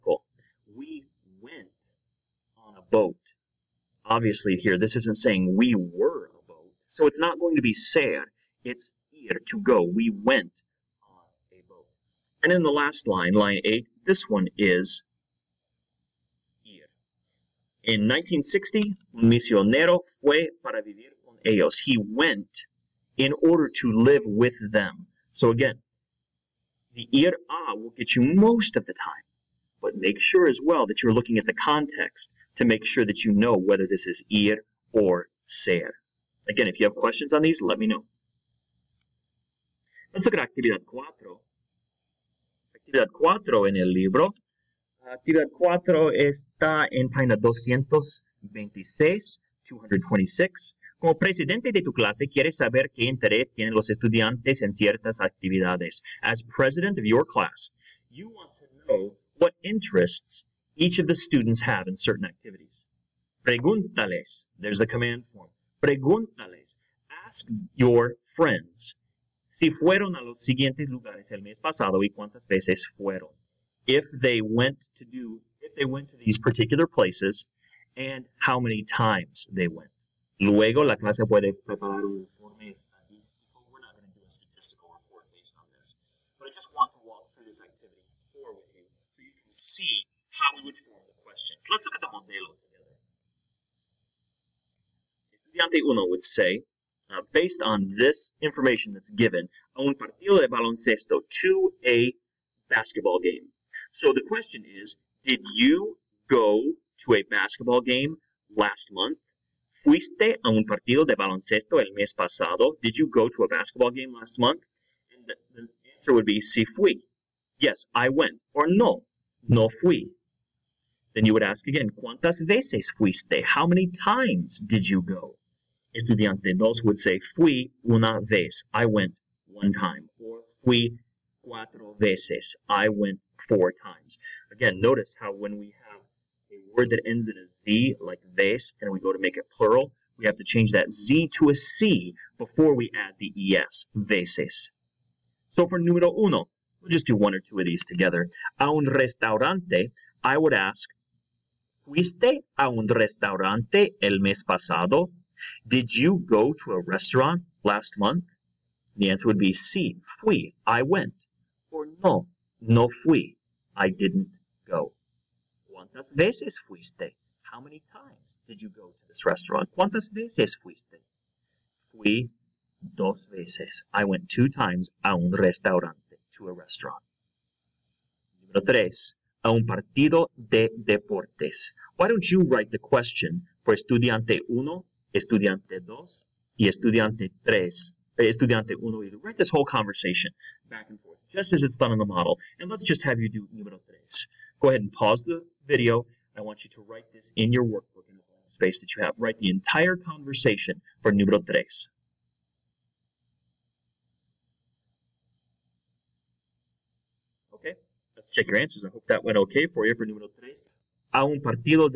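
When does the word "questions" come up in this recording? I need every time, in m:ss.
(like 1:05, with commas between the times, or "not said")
0:36, 1:31, 1:44, 3:02.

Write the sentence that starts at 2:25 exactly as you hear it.
So for número uno, we'll just do one or two of these together.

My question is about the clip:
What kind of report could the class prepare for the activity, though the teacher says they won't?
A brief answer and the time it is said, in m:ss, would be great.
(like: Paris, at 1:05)
Statistical report, at 1:22.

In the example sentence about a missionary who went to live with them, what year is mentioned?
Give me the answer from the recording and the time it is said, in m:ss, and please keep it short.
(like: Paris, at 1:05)
1960, at 0:18.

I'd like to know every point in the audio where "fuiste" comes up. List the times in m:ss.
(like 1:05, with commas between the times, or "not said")
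1:49, 2:02, 2:31, 2:46, 2:50.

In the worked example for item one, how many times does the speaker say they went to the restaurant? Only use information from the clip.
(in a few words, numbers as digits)
2.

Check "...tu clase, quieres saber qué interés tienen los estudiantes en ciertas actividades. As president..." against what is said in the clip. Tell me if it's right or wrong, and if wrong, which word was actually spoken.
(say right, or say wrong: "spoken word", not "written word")
right.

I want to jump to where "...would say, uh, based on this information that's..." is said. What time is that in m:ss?
1:36.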